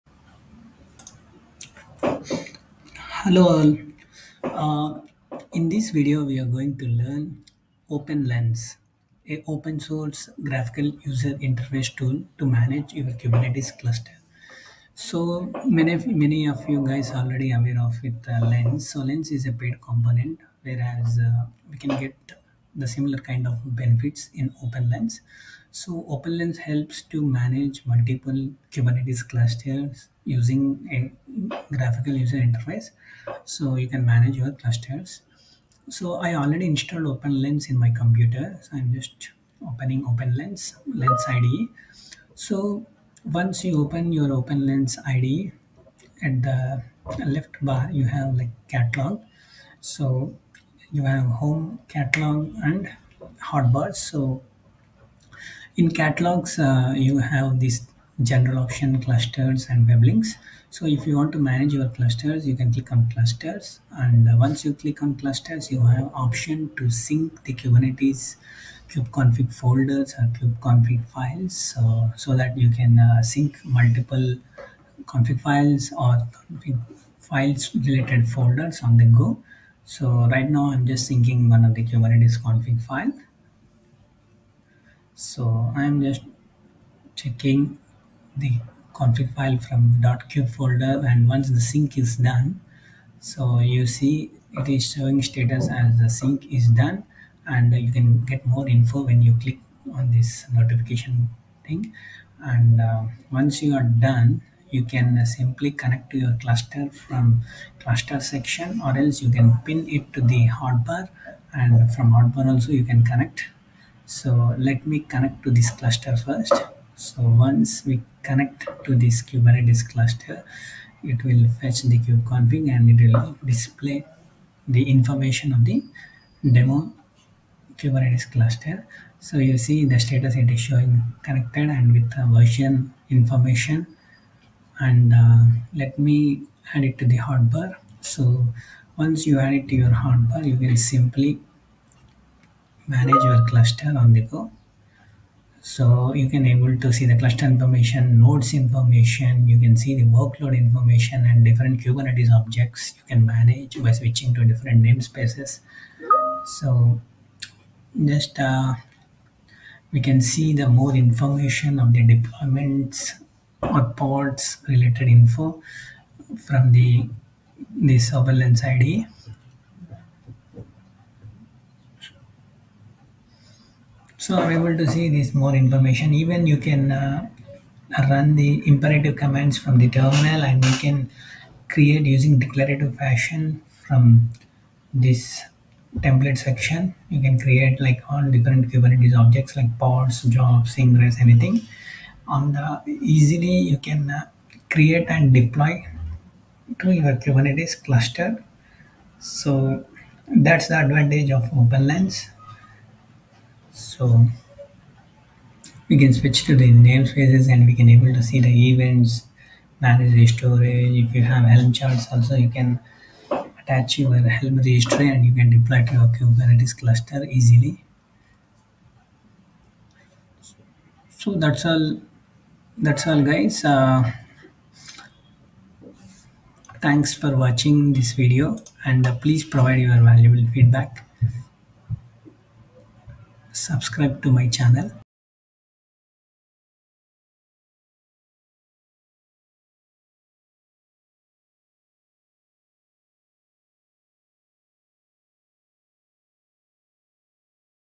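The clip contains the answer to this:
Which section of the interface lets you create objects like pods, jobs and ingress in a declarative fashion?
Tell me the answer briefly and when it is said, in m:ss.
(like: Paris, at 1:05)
Template section, at 3:06.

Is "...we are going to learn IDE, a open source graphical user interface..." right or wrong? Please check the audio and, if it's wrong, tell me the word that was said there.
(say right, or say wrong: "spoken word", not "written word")
wrong: "OpenLens", not "IDE".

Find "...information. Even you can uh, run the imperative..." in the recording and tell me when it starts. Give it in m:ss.
2:55.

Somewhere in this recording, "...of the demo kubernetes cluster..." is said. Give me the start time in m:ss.
2:05.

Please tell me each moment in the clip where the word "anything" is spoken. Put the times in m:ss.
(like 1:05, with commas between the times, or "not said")
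3:11.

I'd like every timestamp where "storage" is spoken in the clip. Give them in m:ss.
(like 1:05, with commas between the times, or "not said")
3:30.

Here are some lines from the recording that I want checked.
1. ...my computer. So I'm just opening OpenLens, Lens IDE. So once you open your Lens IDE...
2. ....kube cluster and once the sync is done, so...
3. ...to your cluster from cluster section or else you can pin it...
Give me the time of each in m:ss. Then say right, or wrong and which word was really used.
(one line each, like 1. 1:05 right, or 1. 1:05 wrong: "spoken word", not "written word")
1. 0:37 wrong: "OpenLens", not "Lens"
2. 1:30 wrong: "folder", not "cluster"
3. 1:46 right.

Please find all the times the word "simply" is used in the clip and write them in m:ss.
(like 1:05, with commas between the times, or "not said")
1:45, 2:20.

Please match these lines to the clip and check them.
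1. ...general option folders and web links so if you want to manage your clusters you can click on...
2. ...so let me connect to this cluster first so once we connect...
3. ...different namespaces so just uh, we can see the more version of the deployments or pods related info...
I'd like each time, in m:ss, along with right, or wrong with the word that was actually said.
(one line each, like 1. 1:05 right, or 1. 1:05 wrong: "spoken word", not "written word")
1. 0:58 wrong: "clusters", not "folders"
2. 1:54 right
3. 2:34 wrong: "information", not "version".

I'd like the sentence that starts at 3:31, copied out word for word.
If you have Helm charts also, you can attach your Helm registry and you can deploy to your Kubernetes cluster easily.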